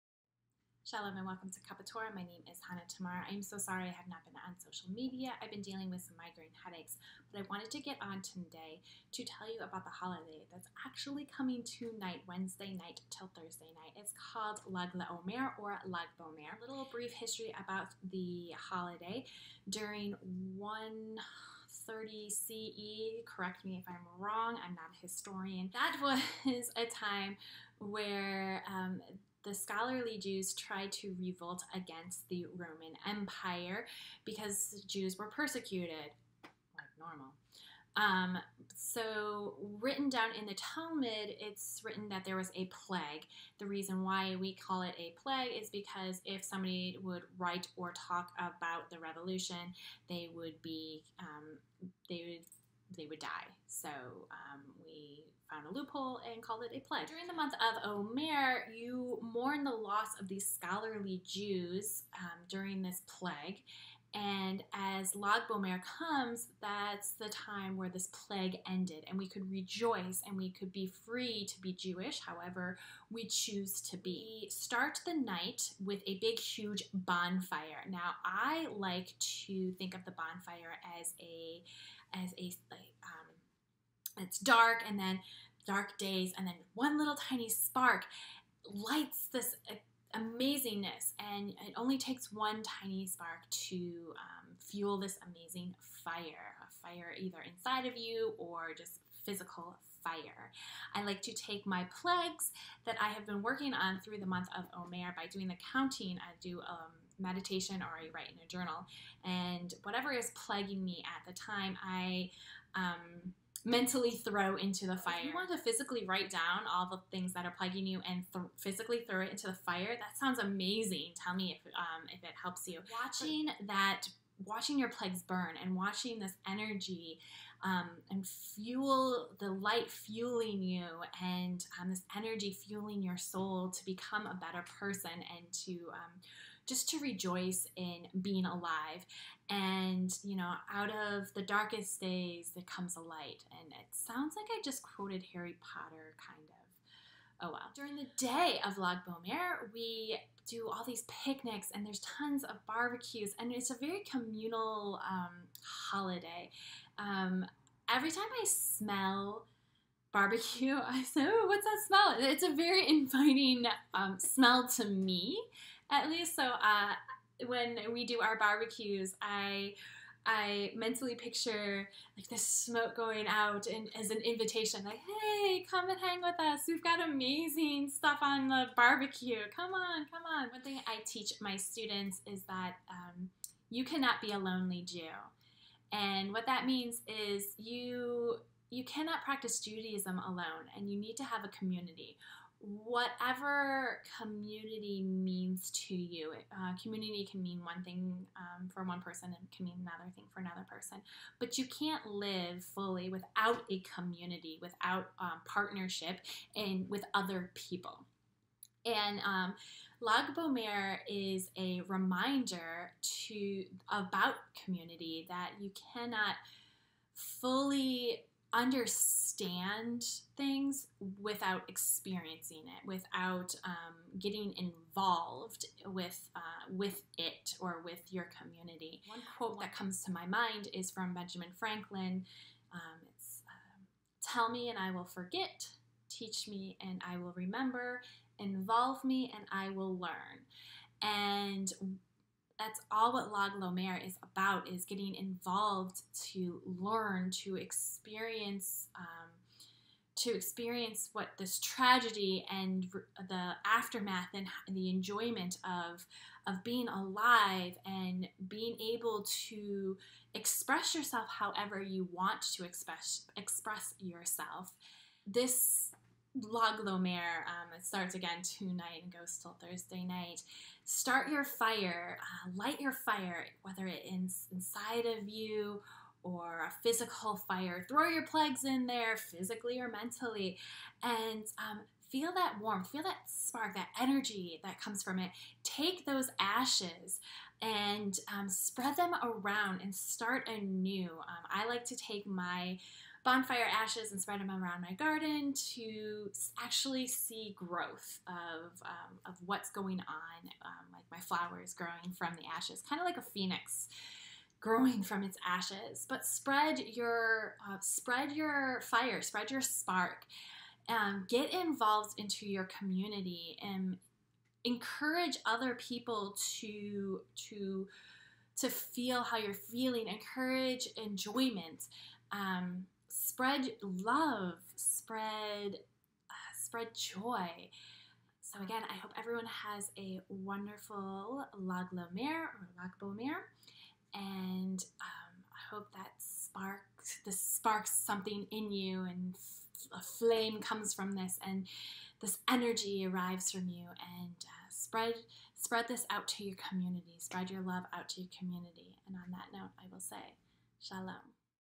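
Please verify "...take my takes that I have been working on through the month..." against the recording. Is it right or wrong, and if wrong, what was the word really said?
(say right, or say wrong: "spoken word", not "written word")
wrong: "plagues", not "takes".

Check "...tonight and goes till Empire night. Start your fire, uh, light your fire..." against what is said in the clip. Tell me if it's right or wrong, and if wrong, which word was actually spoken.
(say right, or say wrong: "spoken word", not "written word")
wrong: "Thursday", not "Empire".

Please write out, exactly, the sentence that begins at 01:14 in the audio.
start the night with a big, huge bonfire.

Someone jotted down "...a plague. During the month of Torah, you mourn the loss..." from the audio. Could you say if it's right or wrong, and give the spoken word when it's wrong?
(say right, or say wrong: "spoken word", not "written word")
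wrong: "Omer", not "Torah".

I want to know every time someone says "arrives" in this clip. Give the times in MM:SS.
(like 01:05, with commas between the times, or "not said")
05:43.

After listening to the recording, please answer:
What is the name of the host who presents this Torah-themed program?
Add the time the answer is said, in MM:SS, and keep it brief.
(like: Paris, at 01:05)
Hannah Tamar, at 00:02.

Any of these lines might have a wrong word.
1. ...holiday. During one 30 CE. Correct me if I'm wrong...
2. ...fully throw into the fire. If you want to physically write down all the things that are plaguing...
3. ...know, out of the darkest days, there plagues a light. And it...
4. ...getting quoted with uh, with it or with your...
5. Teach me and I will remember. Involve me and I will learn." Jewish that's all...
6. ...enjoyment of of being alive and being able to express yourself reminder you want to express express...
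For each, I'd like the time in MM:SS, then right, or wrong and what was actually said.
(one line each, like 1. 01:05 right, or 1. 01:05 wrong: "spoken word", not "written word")
1. 00:18 right
2. 01:53 wrong: "mentally", not "fully"
3. 02:20 wrong: "comes", not "plagues"
4. 03:44 wrong: "involved", not "quoted"
5. 03:56 wrong: "And", not "Jewish"
6. 04:14 wrong: "however", not "reminder".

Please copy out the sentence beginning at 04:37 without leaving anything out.
Throw your plugs in there, physically or mentally, and um, feel that warmth, feel that spark, that energy that comes from it.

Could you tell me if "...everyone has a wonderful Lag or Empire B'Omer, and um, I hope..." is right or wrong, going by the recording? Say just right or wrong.
wrong.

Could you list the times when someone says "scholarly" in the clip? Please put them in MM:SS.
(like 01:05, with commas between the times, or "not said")
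00:29, 01:00.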